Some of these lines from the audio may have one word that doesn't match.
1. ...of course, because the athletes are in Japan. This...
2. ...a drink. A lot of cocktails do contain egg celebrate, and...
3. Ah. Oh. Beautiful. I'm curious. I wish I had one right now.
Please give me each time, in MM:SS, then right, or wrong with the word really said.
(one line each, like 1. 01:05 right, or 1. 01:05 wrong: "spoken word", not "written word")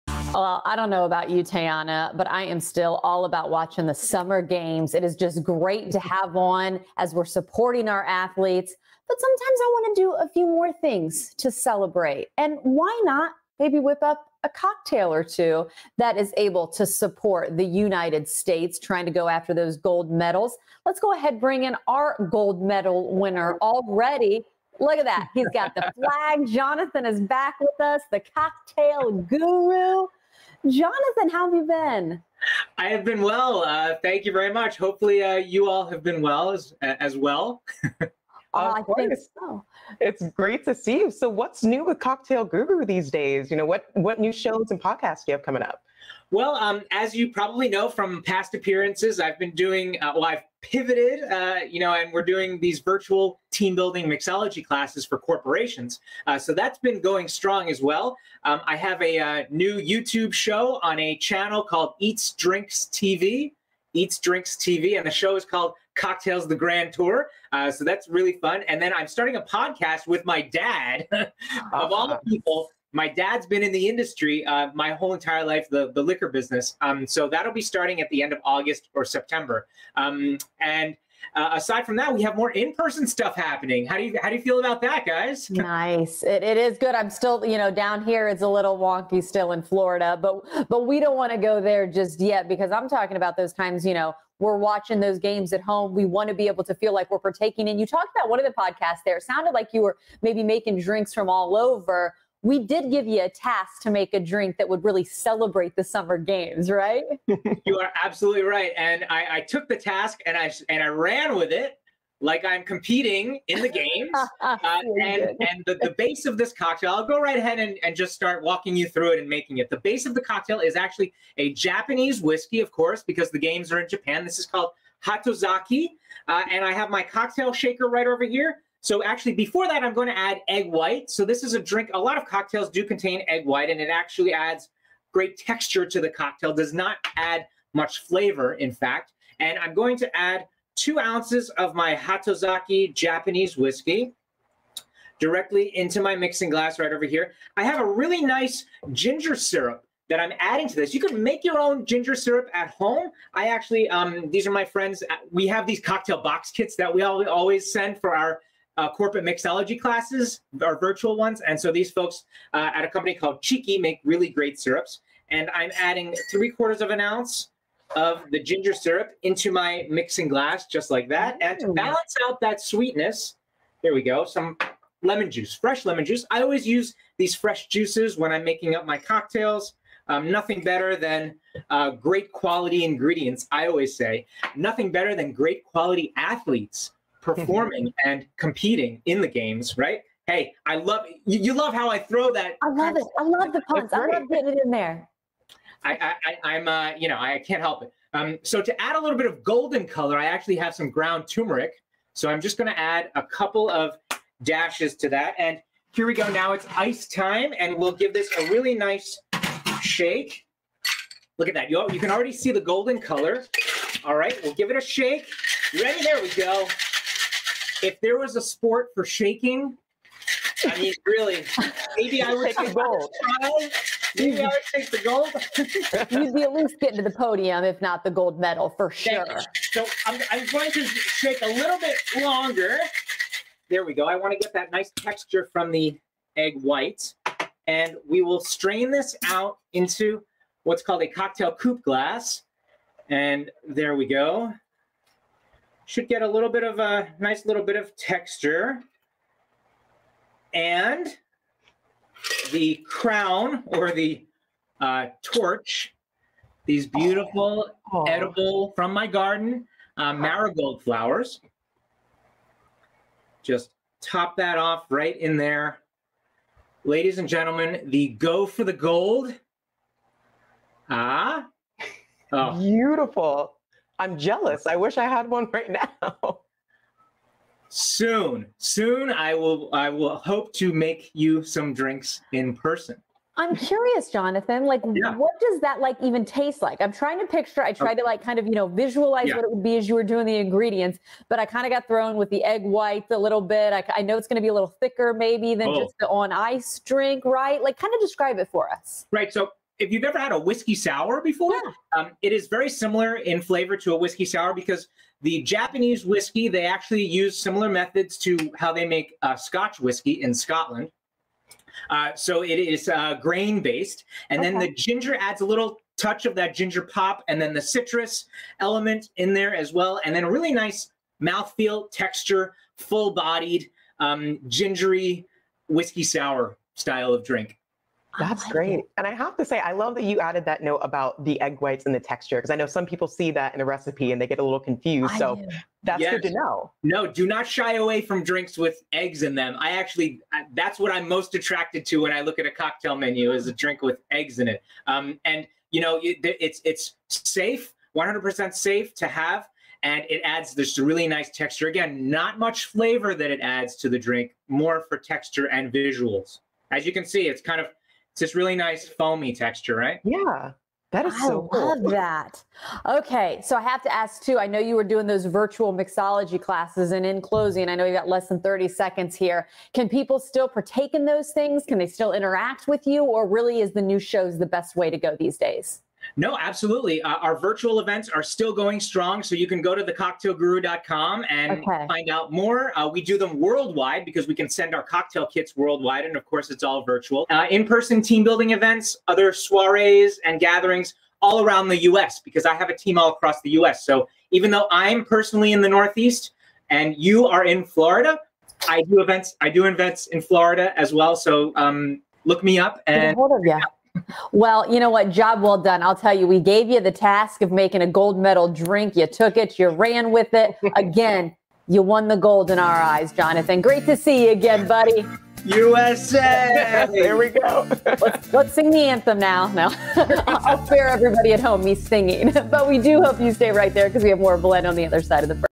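1. 02:02 wrong: "games", not "athletes"
2. 02:11 wrong: "white", not "celebrate"
3. 04:30 wrong: "jealous", not "curious".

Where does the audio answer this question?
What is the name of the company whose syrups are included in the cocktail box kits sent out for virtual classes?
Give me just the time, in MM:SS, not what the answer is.
02:43.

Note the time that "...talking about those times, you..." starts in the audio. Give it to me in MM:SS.
01:32.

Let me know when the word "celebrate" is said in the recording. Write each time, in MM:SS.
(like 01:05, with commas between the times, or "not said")
00:11, 01:45.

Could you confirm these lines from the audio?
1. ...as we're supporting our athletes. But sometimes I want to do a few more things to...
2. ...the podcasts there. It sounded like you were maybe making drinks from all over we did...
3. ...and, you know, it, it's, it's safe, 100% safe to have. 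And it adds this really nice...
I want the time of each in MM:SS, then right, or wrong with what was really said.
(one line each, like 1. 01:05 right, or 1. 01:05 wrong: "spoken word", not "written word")
1. 00:06 right
2. 01:38 right
3. 05:45 right.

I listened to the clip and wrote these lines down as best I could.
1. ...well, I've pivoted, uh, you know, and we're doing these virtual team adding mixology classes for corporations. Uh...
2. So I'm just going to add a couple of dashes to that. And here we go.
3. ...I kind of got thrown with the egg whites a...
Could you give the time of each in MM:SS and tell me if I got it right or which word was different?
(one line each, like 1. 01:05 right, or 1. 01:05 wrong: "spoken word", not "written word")
1. 00:50 wrong: "building", not "adding"
2. 03:22 right
3. 04:51 right.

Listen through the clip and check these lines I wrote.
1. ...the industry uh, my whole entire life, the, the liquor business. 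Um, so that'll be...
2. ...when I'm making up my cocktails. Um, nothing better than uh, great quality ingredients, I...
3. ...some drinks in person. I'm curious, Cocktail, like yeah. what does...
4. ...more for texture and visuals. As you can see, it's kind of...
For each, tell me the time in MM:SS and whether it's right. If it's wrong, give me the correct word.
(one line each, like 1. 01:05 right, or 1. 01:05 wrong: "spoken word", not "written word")
1. 01:13 right
2. 02:58 right
3. 04:41 wrong: "Jonathan", not "Cocktail"
4. 05:54 right.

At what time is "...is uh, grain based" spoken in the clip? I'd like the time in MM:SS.
05:12.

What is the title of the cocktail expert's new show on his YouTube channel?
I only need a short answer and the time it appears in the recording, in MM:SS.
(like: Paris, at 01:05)
Cocktails the Grand Tour, at 01:05.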